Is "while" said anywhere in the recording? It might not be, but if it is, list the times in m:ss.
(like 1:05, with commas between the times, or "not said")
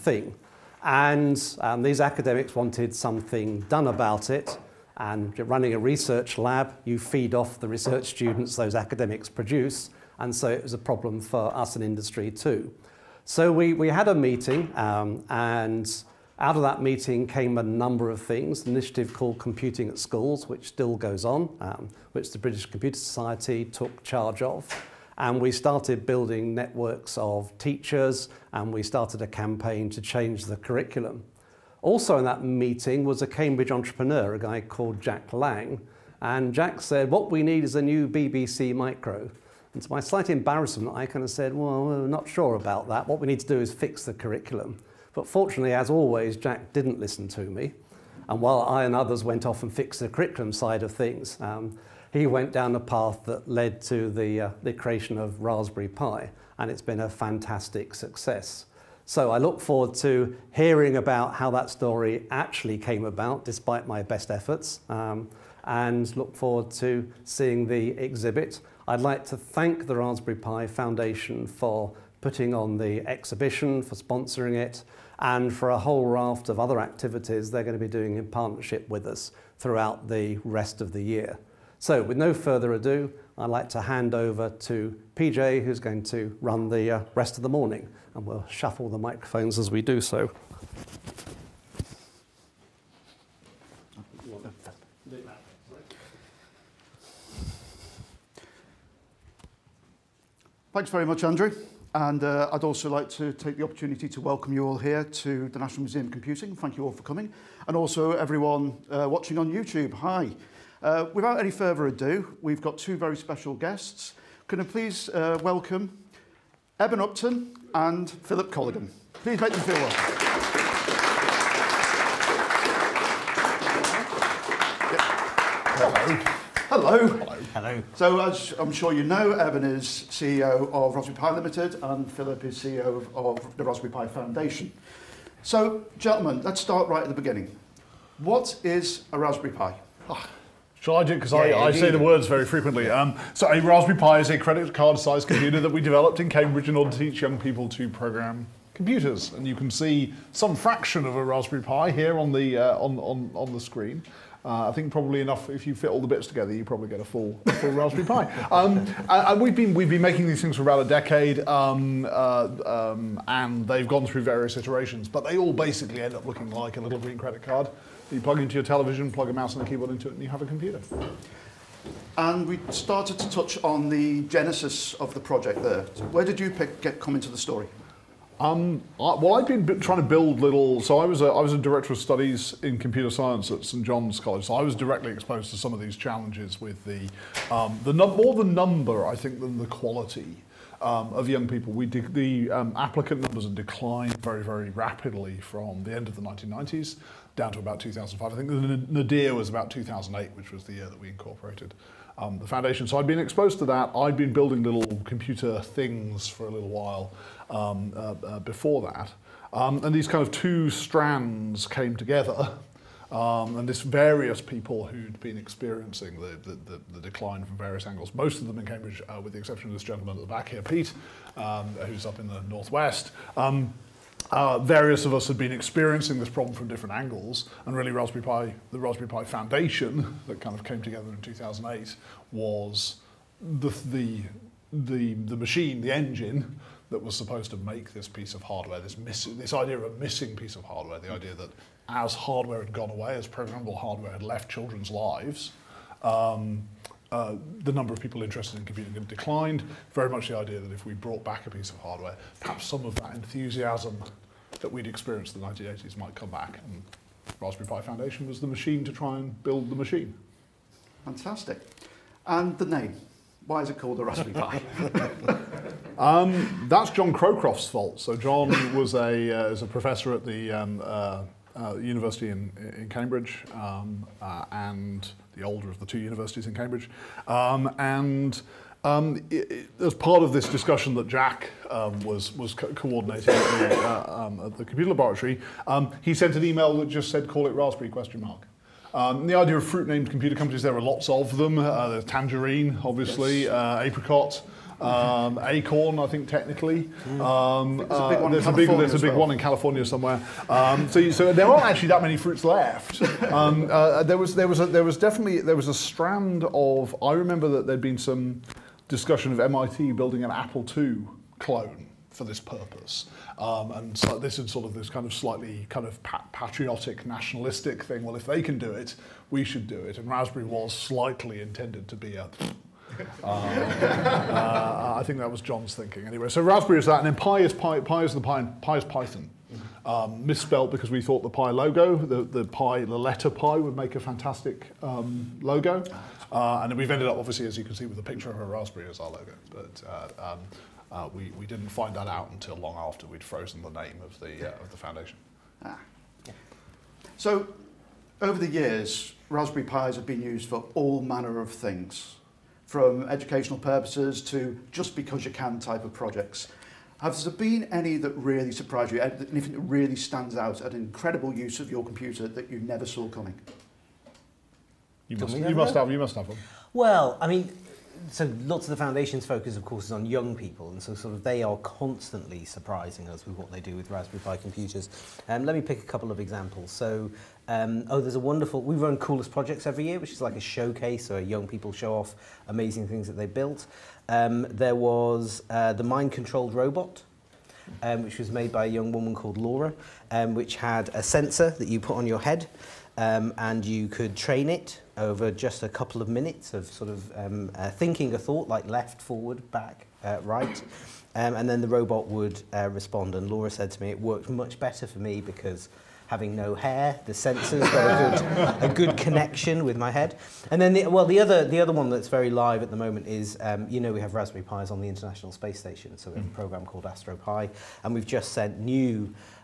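0:48, 3:26.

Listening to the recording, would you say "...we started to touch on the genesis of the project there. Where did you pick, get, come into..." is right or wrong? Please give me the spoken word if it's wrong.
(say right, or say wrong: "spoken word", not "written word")
right.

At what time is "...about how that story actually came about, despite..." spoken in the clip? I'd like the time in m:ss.
1:00.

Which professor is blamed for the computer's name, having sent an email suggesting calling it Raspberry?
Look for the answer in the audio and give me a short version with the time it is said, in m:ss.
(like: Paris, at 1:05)
John Crowcroft, at 4:26.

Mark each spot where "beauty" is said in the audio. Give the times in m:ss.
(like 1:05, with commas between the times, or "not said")
not said.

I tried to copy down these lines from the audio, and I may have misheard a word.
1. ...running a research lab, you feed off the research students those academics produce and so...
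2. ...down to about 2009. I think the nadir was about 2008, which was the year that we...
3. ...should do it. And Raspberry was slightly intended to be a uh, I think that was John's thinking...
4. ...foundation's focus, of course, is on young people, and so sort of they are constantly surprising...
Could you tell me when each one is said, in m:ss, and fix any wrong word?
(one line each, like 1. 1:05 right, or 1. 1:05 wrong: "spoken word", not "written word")
1. 0:05 right
2. 3:17 wrong: "2005", not "2009"
3. 5:19 right
4. 6:08 right.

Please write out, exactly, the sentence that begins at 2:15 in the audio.
So, gentlemen, let's start right at the beginning.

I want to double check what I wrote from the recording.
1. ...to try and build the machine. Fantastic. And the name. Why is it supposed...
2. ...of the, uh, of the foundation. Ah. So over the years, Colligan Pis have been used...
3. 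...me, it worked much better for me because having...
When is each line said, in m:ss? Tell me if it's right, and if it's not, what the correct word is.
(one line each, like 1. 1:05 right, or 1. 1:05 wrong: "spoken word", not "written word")
1. 4:18 wrong: "called", not "supposed"
2. 5:44 wrong: "Raspberry", not "Colligan"
3. 6:43 right.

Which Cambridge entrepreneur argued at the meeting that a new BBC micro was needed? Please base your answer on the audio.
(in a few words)
Jack Lang.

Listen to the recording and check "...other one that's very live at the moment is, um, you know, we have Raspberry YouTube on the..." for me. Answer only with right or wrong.
wrong.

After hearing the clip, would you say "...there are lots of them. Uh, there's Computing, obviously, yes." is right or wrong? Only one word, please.
wrong.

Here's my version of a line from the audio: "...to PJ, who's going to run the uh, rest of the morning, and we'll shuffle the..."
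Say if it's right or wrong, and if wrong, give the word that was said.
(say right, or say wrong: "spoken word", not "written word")
right.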